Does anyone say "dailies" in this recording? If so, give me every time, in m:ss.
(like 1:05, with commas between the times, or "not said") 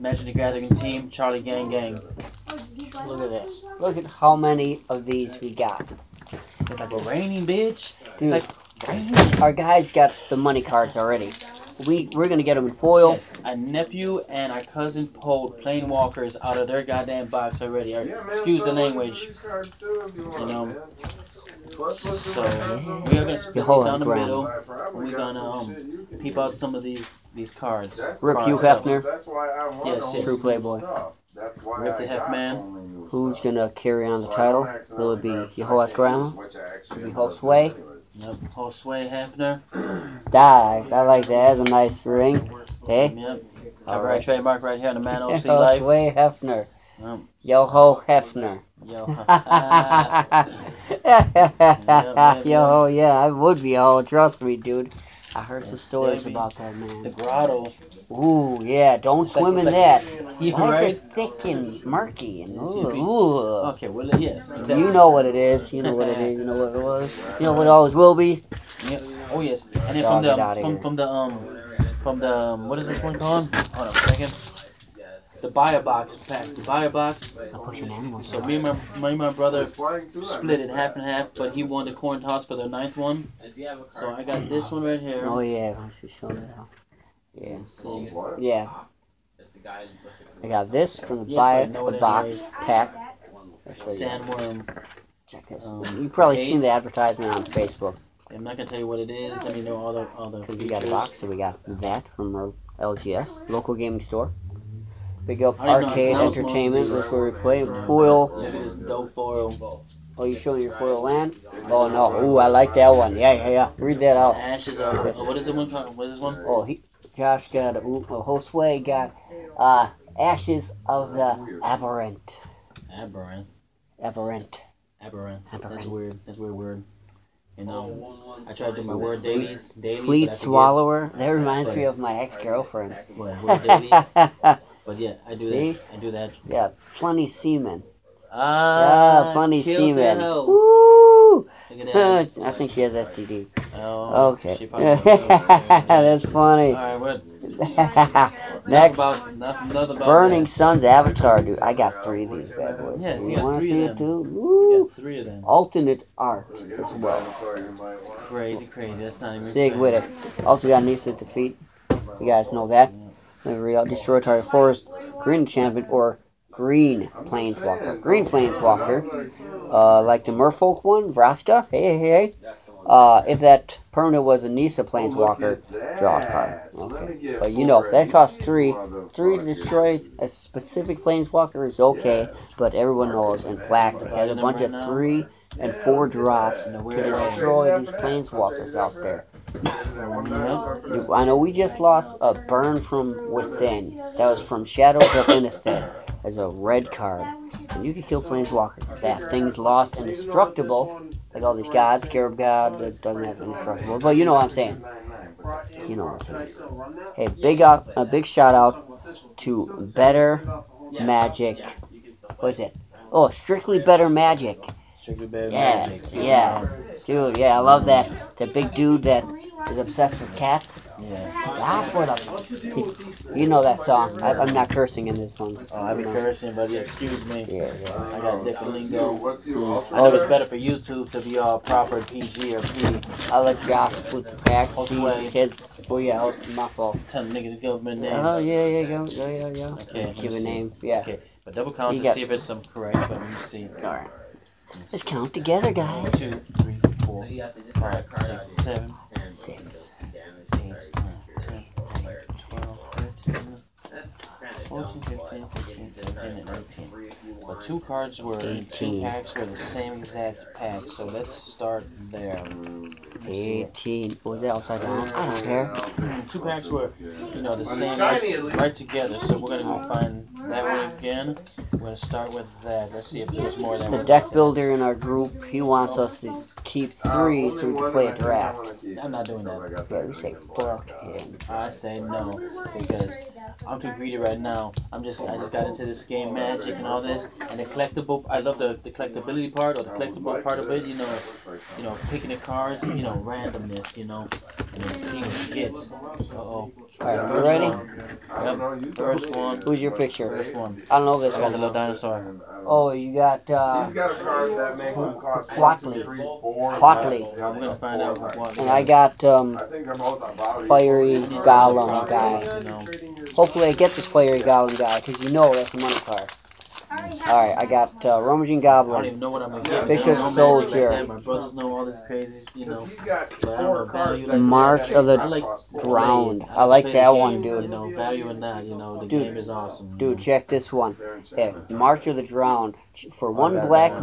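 2:09.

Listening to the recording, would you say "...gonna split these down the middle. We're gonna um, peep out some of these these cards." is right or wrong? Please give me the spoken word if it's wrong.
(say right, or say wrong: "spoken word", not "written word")
right.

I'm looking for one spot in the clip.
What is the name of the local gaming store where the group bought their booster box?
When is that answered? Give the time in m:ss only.
1:45.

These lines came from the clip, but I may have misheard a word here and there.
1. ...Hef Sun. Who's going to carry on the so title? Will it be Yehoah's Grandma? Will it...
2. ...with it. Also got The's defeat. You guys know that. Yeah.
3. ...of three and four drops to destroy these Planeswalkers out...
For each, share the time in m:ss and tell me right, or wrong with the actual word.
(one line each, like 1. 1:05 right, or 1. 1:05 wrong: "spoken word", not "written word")
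1. 0:32 wrong: "Man", not "Sun"
2. 2:39 wrong: "Nissa", not "The"
3. 3:04 right.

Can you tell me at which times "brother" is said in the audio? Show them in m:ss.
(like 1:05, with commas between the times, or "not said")
1:19, 5:21.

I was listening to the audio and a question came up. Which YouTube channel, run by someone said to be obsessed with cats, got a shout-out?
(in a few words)
Strictly Better Magic.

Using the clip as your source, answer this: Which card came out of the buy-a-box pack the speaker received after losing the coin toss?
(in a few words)
Sandworm.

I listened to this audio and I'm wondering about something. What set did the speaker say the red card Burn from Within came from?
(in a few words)
Shadows of Innistrad.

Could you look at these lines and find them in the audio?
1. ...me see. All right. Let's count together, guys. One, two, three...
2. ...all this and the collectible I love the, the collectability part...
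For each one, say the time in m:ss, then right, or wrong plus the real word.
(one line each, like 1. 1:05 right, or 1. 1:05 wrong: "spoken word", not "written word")
1. 4:03 right
2. 4:46 right.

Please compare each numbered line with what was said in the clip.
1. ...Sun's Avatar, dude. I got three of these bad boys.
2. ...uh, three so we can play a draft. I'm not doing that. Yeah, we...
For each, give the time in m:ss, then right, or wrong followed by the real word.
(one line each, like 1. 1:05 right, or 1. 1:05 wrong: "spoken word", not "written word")
1. 2:30 right
2. 4:37 right.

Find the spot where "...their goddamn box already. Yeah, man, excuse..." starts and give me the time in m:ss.
0:16.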